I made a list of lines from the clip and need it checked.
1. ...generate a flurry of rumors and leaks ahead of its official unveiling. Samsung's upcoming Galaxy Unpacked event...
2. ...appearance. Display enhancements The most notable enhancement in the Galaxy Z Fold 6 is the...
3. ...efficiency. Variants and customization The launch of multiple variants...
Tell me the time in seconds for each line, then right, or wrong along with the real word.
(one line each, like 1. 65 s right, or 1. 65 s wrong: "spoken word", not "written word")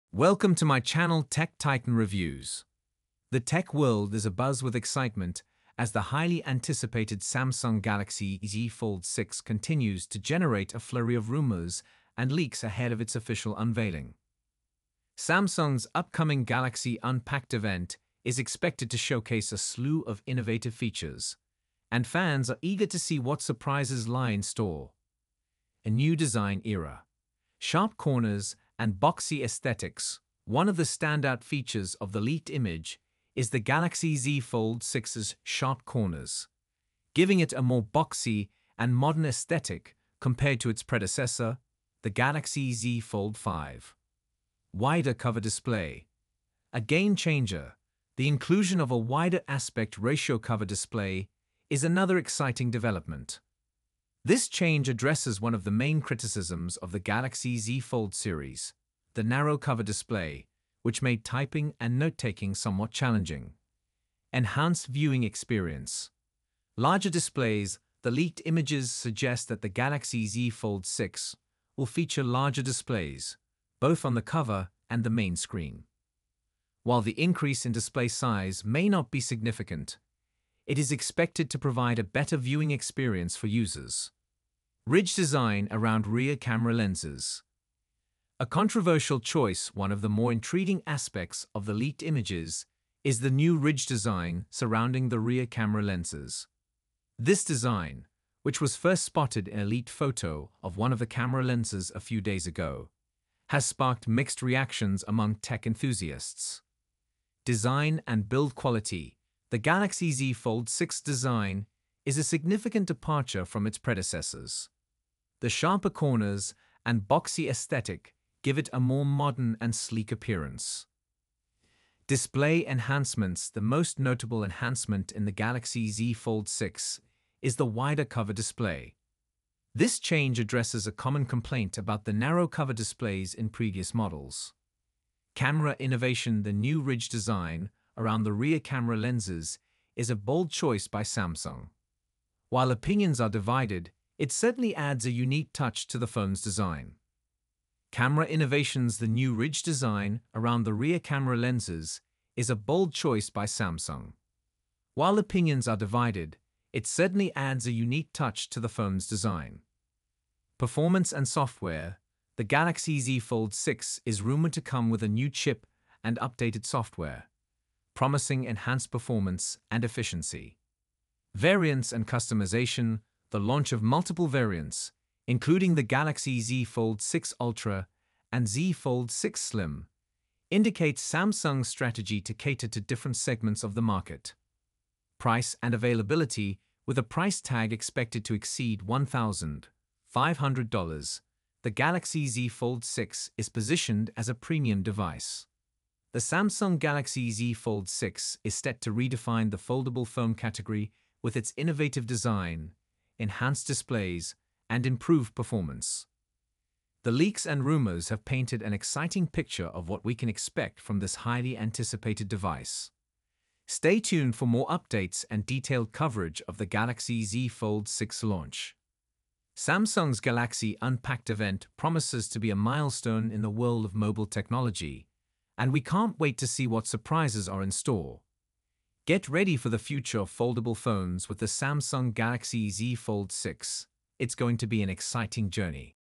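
1. 10 s right
2. 120 s right
3. 169 s right.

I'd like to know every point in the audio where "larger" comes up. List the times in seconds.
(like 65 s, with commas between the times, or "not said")
66 s, 72 s.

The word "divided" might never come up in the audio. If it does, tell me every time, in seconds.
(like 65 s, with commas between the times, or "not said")
143 s, 155 s.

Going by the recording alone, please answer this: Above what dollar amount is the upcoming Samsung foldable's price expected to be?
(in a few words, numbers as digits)
$1,500.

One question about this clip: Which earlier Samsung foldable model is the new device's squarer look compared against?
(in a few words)
Galaxy Z Fold 5.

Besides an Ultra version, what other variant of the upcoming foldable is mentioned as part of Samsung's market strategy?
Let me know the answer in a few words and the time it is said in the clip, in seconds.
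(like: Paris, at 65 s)
Z Fold 6 Slim, at 178 s.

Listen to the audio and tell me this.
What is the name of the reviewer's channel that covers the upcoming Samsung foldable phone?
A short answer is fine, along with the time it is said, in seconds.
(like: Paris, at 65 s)
Tech Titan Reviews, at 1 s.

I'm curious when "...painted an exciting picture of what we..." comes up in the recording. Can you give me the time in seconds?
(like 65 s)
208 s.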